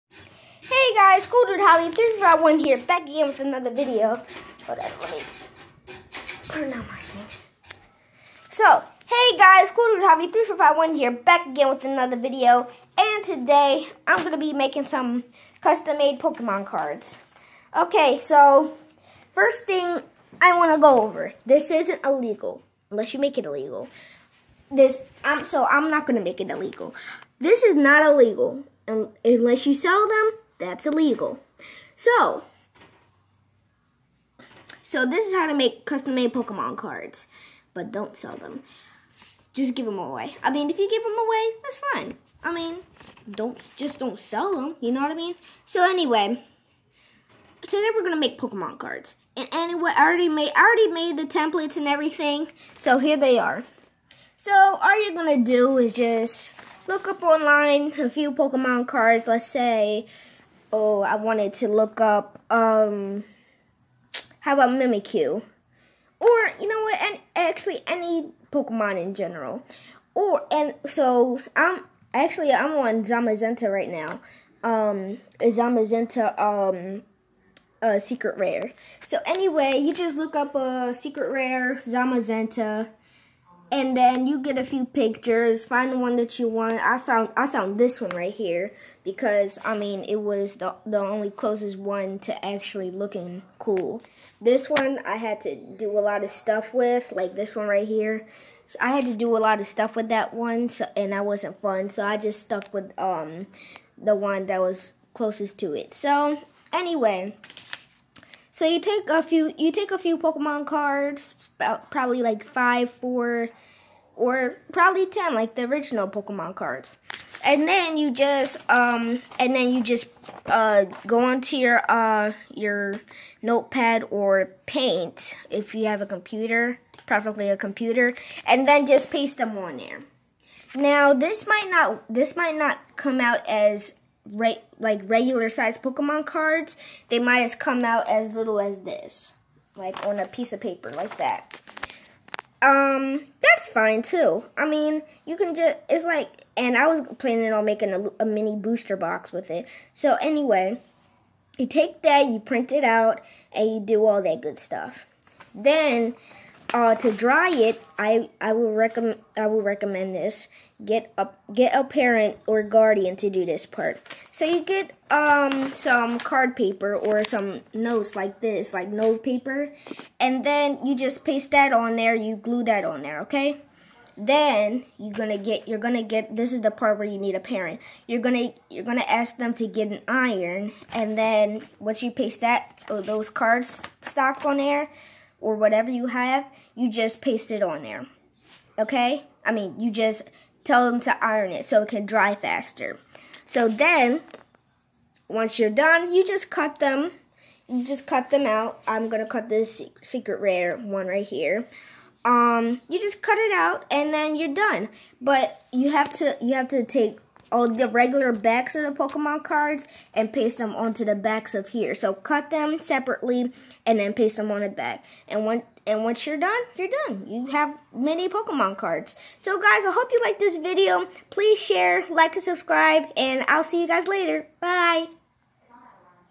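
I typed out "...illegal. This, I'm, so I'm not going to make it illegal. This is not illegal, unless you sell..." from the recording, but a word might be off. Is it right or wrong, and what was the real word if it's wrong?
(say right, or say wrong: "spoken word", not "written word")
right.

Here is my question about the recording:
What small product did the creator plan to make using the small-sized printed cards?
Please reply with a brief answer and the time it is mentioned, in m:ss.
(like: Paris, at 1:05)
A mini booster box, at 2:28.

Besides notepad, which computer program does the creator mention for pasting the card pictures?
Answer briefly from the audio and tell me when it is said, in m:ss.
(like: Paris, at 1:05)
Paint, at 2:04.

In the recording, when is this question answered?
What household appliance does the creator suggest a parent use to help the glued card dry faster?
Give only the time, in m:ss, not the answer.
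2:59.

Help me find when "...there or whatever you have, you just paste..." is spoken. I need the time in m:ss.
3:04.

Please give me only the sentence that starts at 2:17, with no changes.
They might as come out as little as this like on a piece of paper like that.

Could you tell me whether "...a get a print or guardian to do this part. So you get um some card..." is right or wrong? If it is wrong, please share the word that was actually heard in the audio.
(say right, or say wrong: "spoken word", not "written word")
wrong: "parent", not "print".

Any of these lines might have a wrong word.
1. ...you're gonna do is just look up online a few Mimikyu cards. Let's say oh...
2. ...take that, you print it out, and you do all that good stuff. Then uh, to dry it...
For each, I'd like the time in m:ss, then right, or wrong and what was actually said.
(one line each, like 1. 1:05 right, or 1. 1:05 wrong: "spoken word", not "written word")
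1. 0:55 wrong: "Pokemon", not "Mimikyu"
2. 2:31 right.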